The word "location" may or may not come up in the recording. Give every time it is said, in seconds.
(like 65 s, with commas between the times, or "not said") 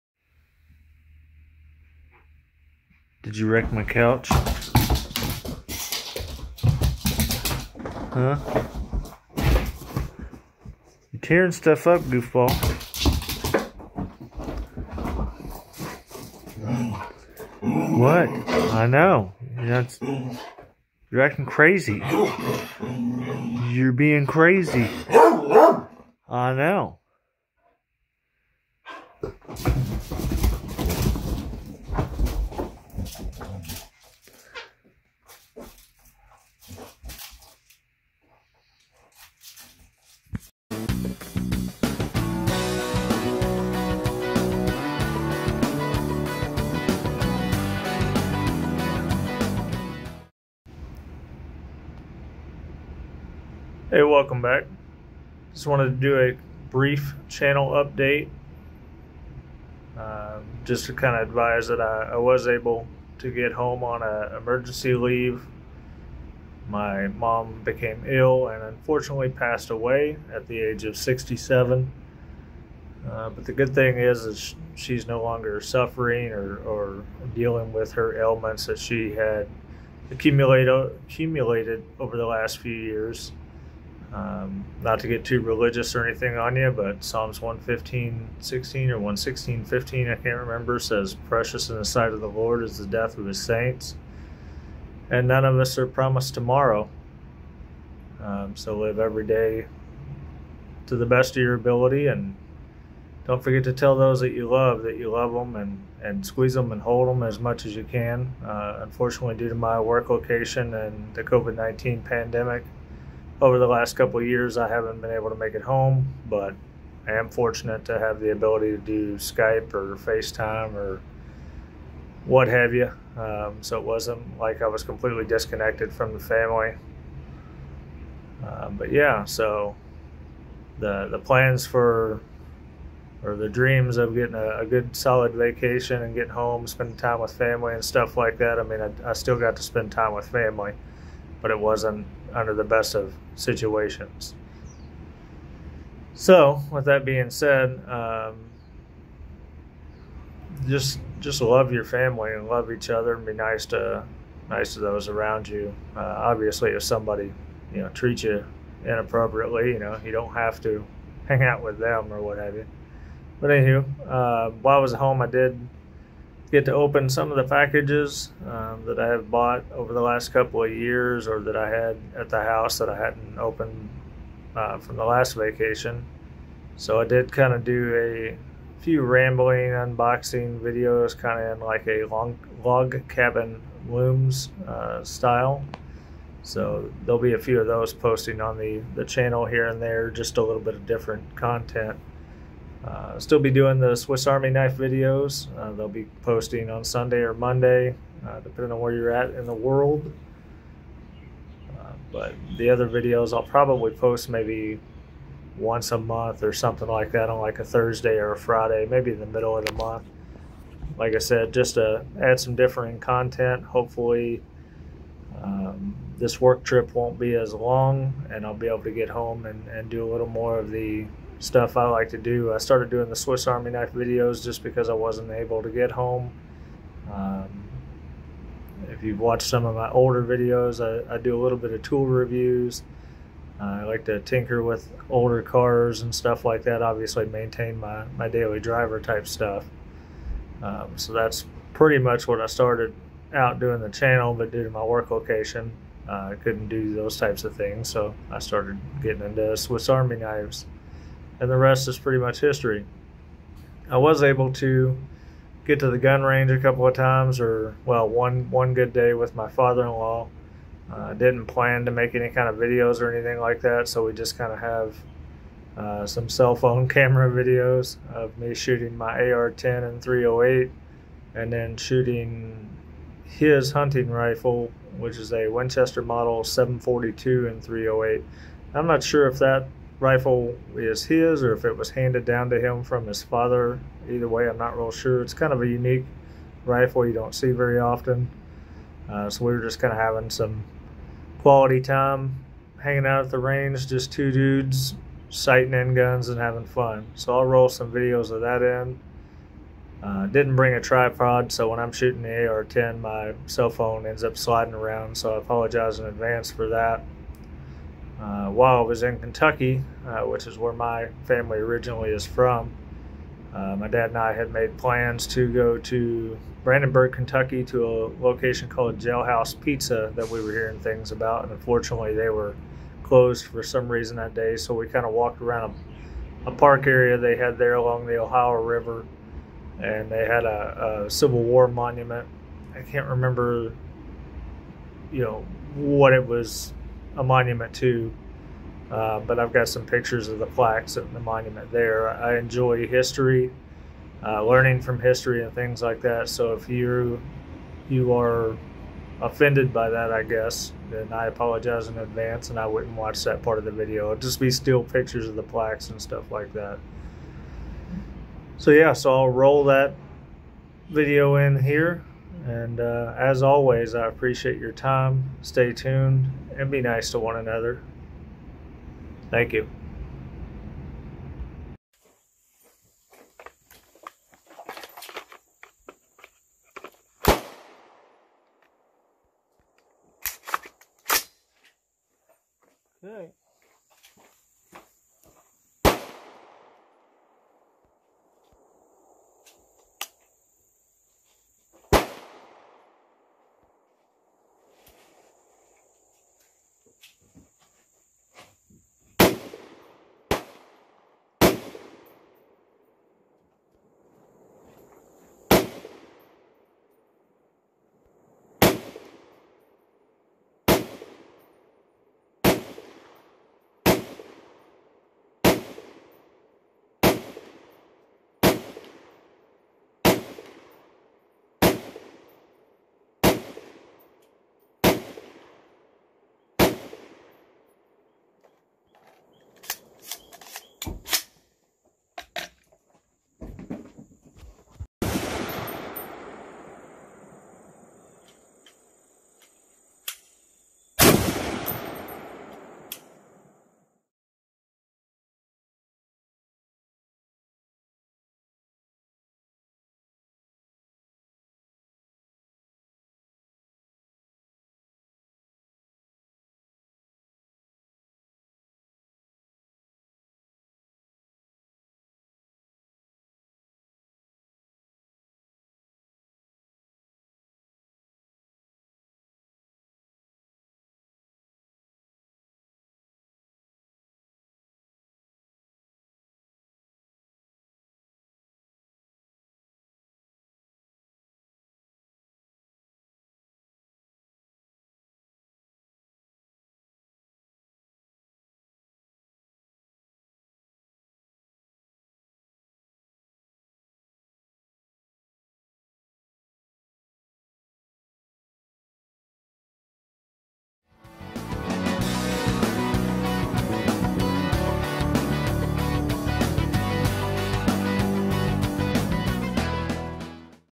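110 s, 245 s, 318 s.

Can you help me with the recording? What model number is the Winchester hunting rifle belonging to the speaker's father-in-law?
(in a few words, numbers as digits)
742.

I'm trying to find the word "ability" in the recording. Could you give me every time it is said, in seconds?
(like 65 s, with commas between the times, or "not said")
101 s, 118 s.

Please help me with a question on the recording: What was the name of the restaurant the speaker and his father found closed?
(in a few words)
Jailhouse Pizza.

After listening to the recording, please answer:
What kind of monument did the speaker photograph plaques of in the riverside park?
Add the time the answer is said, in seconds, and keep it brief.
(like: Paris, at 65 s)
Civil War monument, at 331 s.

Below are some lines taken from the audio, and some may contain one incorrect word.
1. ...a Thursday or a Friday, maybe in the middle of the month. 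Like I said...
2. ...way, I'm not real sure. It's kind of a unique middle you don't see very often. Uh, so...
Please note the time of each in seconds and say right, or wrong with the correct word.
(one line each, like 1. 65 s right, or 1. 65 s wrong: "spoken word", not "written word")
1. 207 s right
2. 284 s wrong: "rifle", not "middle".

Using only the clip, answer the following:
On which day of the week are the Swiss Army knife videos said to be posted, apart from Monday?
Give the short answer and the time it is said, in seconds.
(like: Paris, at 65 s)
Sunday, at 196 s.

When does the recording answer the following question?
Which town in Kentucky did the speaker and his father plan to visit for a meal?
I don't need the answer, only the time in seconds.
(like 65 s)
316 s.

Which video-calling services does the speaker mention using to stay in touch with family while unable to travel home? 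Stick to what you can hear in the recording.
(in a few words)
Skype or FaceTime.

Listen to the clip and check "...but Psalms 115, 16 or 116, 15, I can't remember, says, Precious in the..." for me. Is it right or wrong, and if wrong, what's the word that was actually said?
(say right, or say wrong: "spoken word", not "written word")
right.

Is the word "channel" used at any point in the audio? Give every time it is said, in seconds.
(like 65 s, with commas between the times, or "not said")
57 s, 189 s, 243 s.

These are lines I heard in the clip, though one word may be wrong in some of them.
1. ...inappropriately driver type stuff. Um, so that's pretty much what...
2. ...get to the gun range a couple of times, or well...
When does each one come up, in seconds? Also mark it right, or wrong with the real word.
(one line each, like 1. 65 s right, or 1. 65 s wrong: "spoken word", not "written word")
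1. 238 s wrong: "daily", not "inappropriately"
2. 255 s right.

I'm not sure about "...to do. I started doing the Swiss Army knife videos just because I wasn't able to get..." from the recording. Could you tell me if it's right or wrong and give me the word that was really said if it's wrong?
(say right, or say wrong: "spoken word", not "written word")
right.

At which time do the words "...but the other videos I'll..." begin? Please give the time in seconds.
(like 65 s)
202 s.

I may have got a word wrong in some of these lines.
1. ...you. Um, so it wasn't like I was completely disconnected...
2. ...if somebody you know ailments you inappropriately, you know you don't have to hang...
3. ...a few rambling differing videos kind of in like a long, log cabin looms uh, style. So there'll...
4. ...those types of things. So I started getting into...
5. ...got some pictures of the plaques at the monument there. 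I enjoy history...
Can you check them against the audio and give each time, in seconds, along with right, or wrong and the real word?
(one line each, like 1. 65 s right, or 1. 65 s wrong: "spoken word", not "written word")
1. 122 s right
2. 156 s wrong: "treats", not "ailments"
3. 177 s wrong: "unboxing", not "differing"
4. 246 s right
5. 339 s right.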